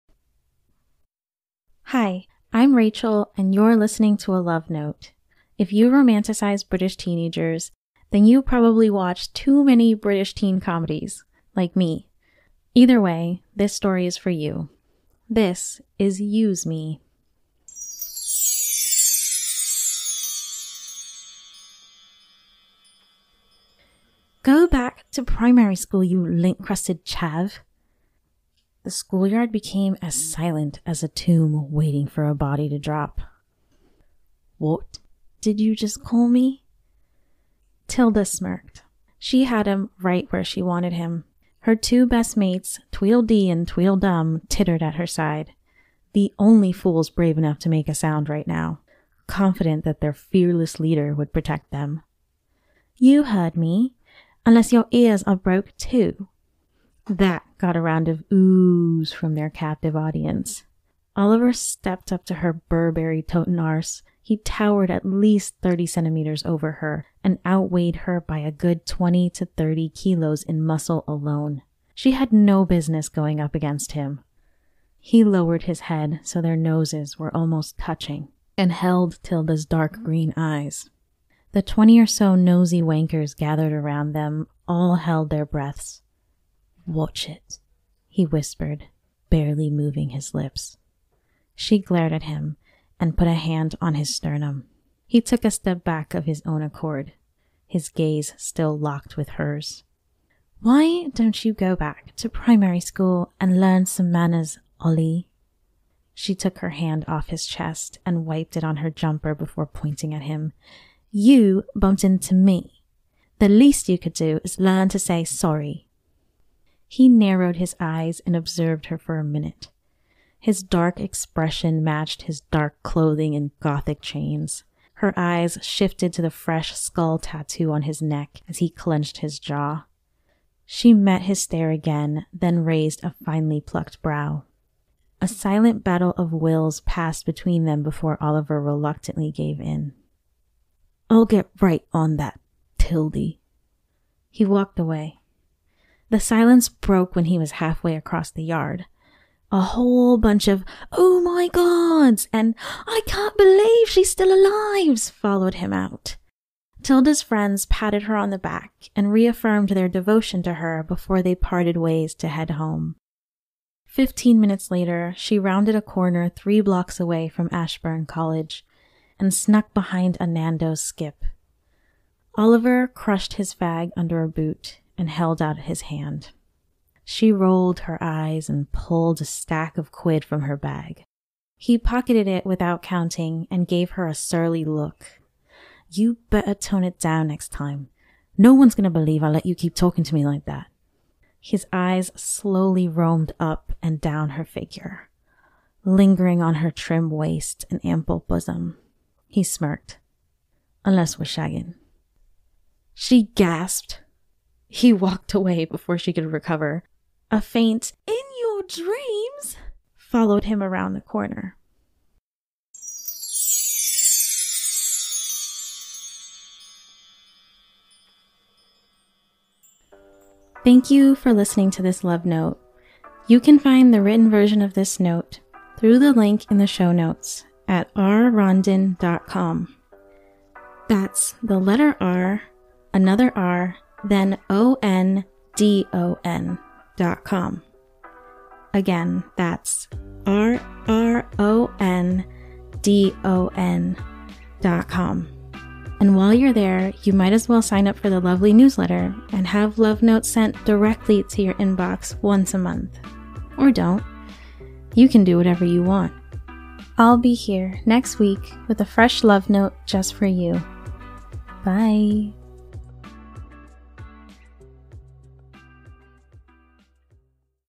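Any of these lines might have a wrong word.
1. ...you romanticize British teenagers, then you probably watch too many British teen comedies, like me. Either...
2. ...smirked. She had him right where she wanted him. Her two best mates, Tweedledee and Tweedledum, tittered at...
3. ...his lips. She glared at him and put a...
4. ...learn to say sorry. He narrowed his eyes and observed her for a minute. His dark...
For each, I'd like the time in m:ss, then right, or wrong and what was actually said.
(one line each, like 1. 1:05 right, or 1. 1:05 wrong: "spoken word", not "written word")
1. 0:05 right
2. 0:38 right
3. 1:30 right
4. 1:54 right.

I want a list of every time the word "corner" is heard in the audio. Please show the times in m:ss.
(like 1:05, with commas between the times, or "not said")
2:45, 3:31.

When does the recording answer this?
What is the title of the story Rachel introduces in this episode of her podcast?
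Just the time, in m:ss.
0:16.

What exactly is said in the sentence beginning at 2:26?
The silence broke when he was halfway across the yard.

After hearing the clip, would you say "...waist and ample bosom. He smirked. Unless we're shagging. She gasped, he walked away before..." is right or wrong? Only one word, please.
right.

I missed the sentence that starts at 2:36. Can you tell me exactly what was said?
Tilda's friends patted her on the back and reaffirmed their devotion to her before they parted ways to head home.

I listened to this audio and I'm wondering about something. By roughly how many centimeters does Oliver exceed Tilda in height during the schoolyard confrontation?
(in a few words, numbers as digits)
30.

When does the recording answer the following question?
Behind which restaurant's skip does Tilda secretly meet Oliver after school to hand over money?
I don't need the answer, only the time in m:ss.
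2:50.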